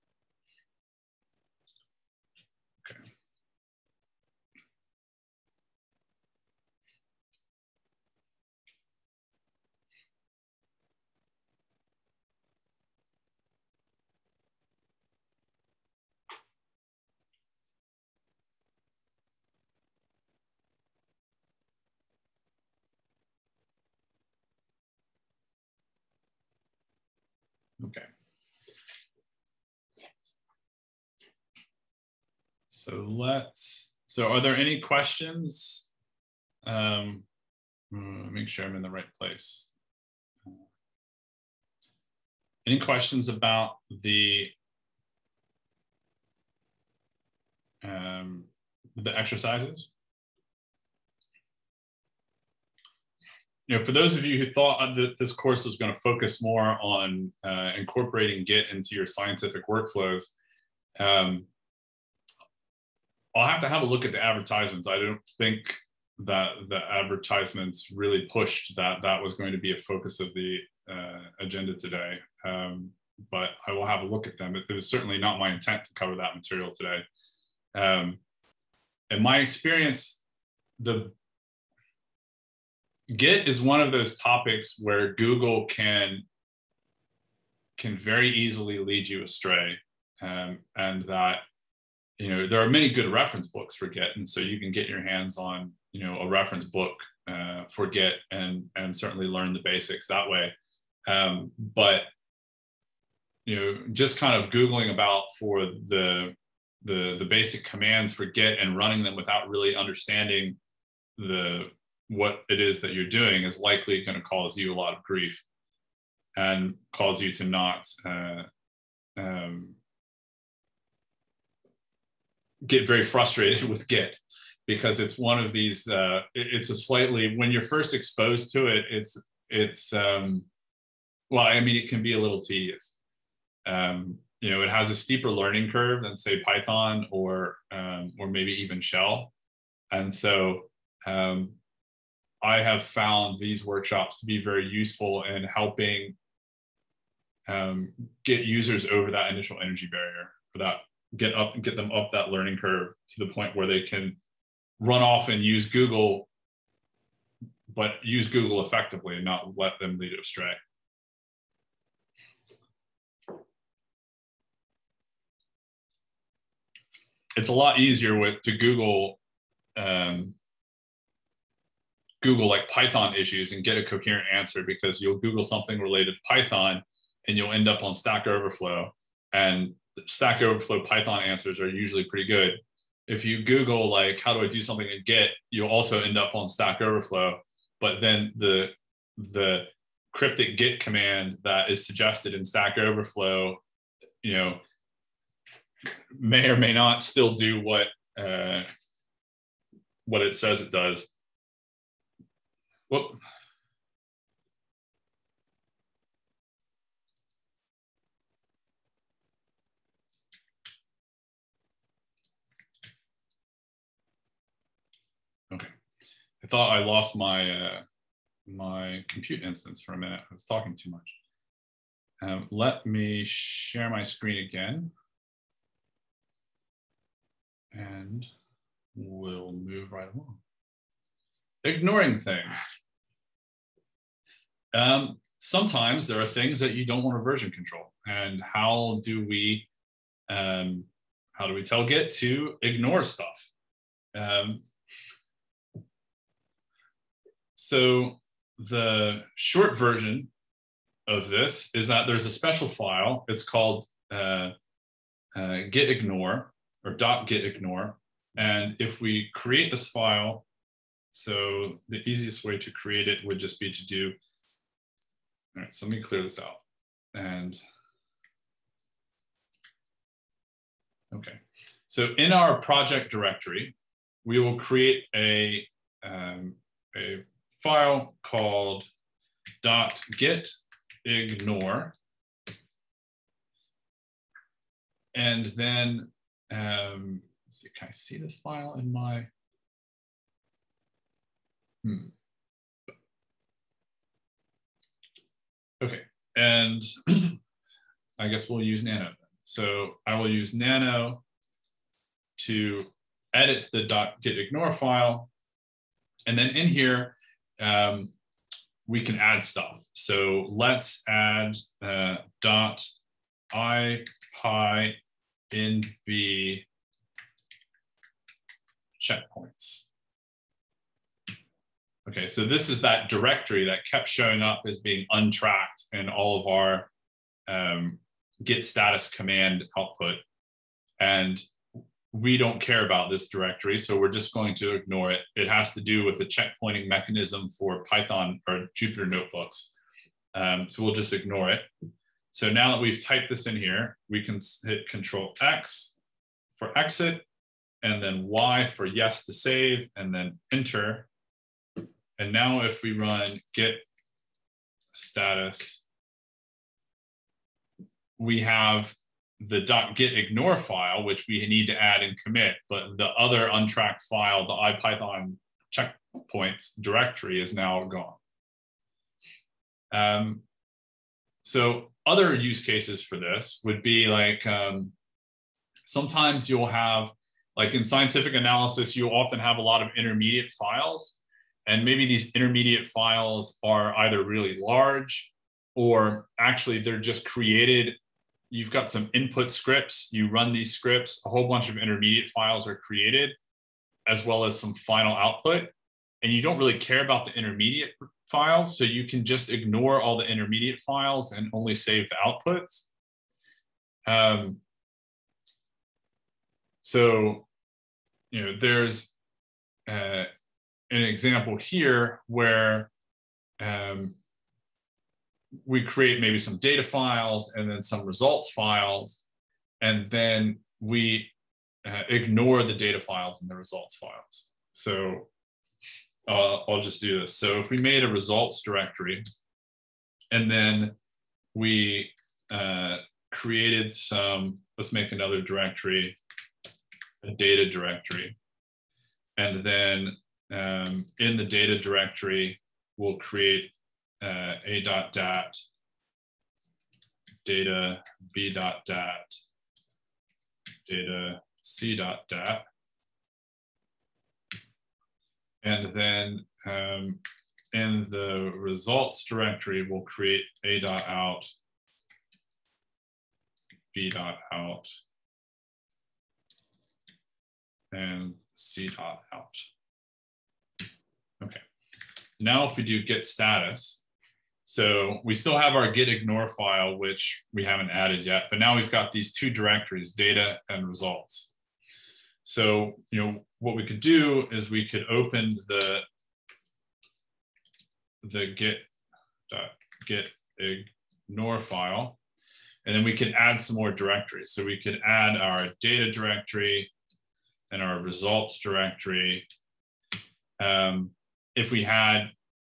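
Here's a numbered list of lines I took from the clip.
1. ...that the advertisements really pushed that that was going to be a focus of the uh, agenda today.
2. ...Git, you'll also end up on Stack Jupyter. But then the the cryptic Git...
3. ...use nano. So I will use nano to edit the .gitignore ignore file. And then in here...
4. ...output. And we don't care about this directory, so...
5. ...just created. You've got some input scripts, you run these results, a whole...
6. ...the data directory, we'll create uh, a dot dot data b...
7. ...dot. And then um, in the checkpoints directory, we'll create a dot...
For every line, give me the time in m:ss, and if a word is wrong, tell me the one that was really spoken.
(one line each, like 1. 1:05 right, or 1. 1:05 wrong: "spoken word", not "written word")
1. 1:06 right
2. 3:05 wrong: "Overflow", not "Jupyter"
3. 4:58 right
4. 5:29 right
5. 6:26 wrong: "scripts", not "results"
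6. 7:21 right
7. 7:32 wrong: "results", not "checkpoints".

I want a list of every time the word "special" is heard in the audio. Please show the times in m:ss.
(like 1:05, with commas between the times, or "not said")
4:12.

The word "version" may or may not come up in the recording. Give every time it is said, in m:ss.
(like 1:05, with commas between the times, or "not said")
3:57, 4:09.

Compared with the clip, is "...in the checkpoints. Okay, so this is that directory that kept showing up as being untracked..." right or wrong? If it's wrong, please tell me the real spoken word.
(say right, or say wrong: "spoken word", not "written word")
right.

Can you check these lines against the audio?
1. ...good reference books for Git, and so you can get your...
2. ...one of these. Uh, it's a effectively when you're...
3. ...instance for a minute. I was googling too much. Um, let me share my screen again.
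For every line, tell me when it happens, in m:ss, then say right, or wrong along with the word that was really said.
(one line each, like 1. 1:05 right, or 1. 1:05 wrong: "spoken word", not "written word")
1. 1:32 right
2. 2:05 wrong: "slightly", not "effectively"
3. 3:39 wrong: "talking", not "googling".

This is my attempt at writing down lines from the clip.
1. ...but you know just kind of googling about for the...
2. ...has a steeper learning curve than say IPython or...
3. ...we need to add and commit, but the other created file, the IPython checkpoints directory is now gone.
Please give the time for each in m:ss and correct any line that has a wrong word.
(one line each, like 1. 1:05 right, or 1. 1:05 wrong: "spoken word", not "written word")
1. 1:41 right
2. 2:14 wrong: "Python", not "IPython"
3. 6:01 wrong: "untracked", not "created".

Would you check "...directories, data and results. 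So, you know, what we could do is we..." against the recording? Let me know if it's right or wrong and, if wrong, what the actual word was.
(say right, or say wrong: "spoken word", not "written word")
right.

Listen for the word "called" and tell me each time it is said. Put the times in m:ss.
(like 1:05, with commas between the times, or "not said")
4:13, 4:38.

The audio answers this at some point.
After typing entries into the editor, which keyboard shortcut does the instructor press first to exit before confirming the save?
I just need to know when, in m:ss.
5:44.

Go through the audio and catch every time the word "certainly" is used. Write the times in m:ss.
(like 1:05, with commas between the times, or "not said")
1:14, 1:38.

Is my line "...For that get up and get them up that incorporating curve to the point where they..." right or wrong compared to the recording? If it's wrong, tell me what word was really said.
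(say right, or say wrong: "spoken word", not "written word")
wrong: "learning", not "incorporating".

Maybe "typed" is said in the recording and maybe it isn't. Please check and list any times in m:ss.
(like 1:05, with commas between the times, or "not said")
5:43.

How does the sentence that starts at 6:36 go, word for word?
And you don't really care about the intermediate files.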